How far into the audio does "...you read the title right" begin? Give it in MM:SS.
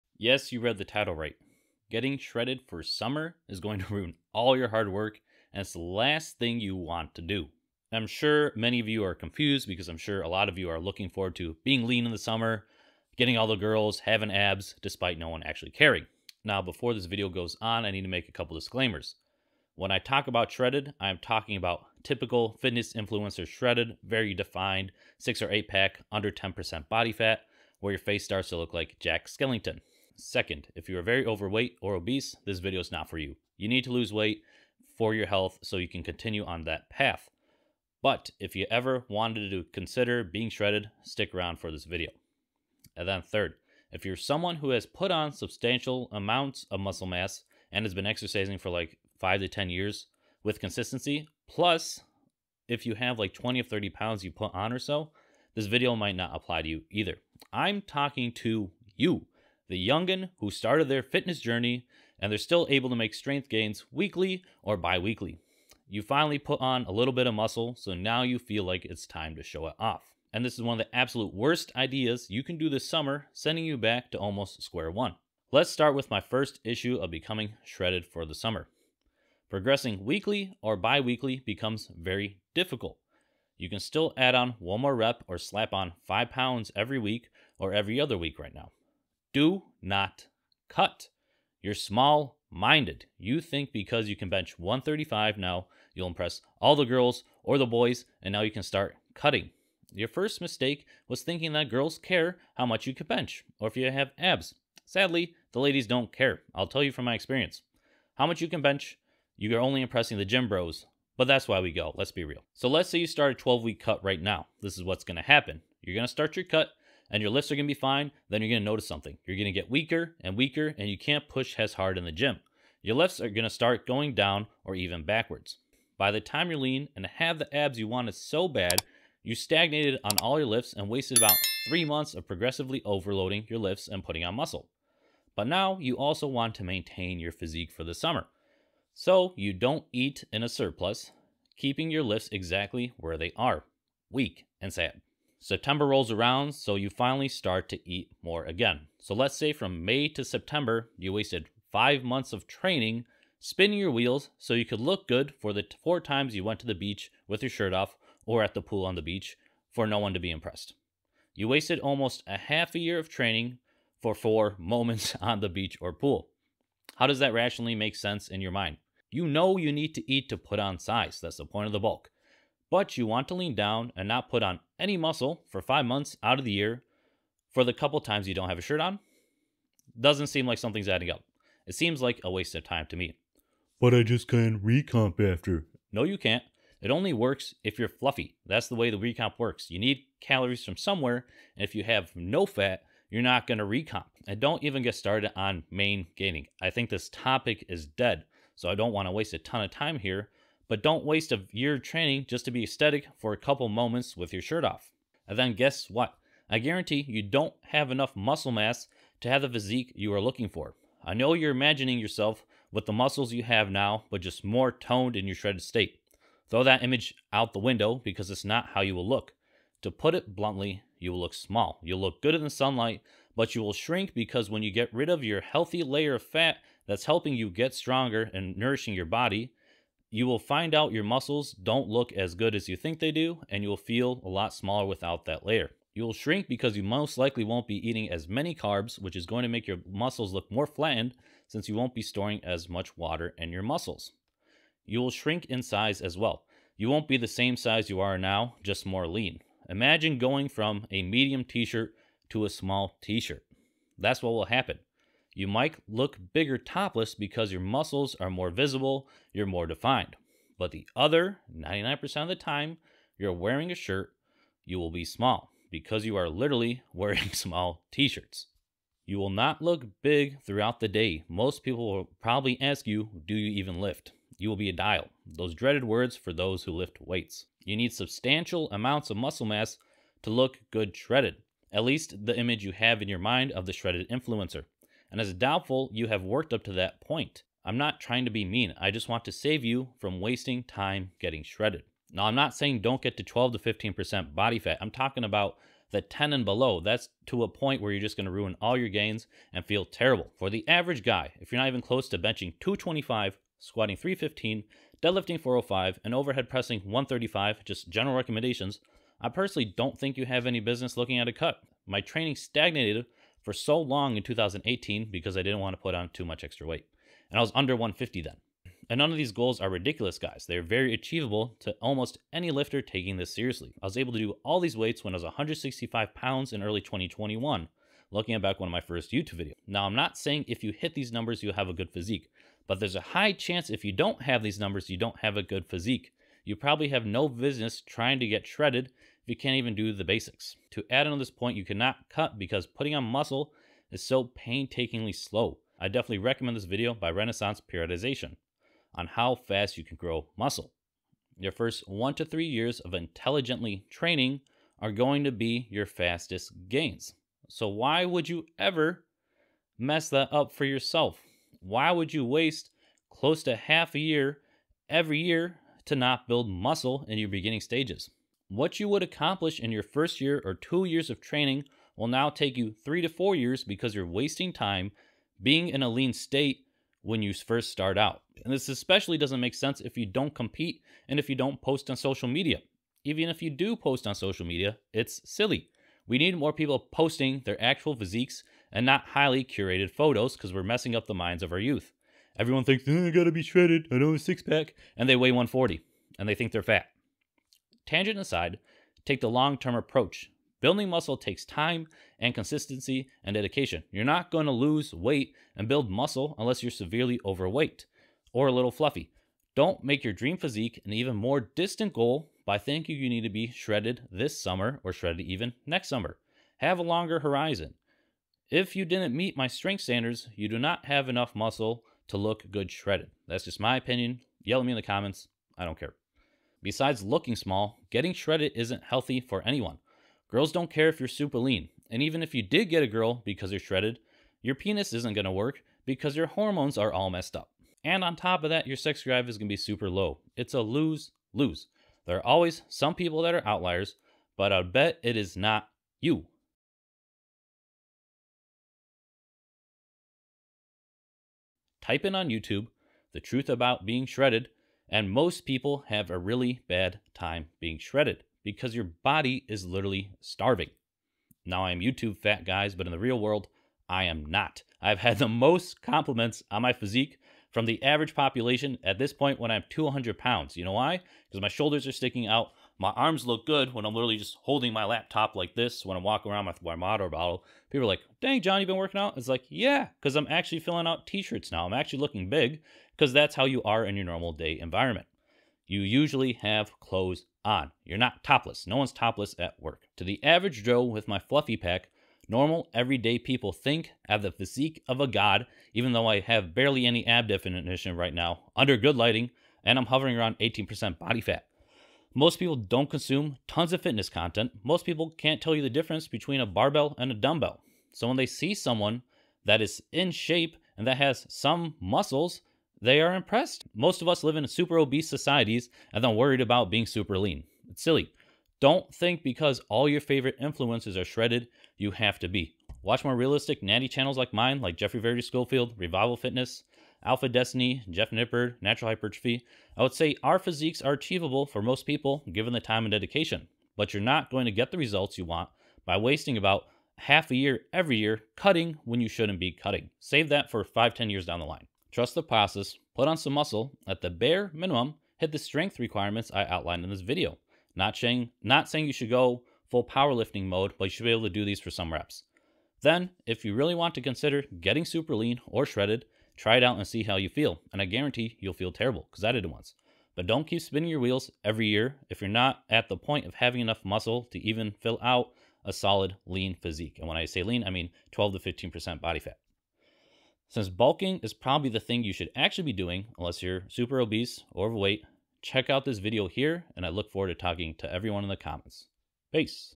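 00:00.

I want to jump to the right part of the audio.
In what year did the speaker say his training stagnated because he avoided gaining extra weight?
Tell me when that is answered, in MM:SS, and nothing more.
05:14.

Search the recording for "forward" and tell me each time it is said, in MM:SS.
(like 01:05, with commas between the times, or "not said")
00:11, 09:37.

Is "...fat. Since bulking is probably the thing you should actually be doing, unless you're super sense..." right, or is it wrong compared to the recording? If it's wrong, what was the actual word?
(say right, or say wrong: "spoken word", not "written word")
wrong: "obese", not "sense".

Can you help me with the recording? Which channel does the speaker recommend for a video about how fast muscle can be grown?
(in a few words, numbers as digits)
Renaissance Periodization.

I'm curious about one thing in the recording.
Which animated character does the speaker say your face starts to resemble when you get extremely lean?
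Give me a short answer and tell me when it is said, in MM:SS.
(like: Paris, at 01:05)
Jack Skellington, at 00:28.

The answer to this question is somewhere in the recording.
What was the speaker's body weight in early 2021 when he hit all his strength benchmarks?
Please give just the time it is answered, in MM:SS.
05:25.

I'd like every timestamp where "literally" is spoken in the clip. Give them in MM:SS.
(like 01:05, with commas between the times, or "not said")
04:26, 07:39, 07:53.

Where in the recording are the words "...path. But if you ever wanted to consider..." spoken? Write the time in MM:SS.
00:36.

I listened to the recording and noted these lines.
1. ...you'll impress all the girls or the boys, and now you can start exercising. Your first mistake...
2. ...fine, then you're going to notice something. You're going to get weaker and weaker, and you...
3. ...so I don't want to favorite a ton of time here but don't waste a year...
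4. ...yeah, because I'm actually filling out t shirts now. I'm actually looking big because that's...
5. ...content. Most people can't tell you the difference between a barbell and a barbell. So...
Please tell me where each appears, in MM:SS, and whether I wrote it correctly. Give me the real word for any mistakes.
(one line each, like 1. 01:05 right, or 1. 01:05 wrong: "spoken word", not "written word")
1. 01:35 wrong: "cutting", not "exercising"
2. 01:57 right
3. 03:18 wrong: "waste", not "favorite"
4. 07:59 right
5. 08:24 wrong: "dumbbell", not "barbell".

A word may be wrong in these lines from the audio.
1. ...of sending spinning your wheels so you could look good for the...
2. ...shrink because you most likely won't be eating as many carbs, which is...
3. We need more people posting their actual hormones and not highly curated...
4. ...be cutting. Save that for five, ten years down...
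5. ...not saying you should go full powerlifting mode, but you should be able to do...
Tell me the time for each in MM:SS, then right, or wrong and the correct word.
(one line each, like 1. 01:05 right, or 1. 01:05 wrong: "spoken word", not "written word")
1. 02:32 wrong: "training", not "sending"
2. 03:56 right
3. 06:26 wrong: "physiques", not "hormones"
4. 08:59 right
5. 09:08 right.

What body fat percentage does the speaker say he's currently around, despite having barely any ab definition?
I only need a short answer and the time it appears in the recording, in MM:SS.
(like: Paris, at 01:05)
18%, at 08:20.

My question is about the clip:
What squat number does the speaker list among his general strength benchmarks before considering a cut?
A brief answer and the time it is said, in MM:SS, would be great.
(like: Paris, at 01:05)
315, at 05:03.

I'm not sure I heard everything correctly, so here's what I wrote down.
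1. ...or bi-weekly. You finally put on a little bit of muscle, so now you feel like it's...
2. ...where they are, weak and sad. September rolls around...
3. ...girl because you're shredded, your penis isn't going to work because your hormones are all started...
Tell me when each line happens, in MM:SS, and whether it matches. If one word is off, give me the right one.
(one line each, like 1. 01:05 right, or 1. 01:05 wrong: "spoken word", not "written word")
1. 01:04 right
2. 02:22 right
3. 07:12 wrong: "messed", not "started".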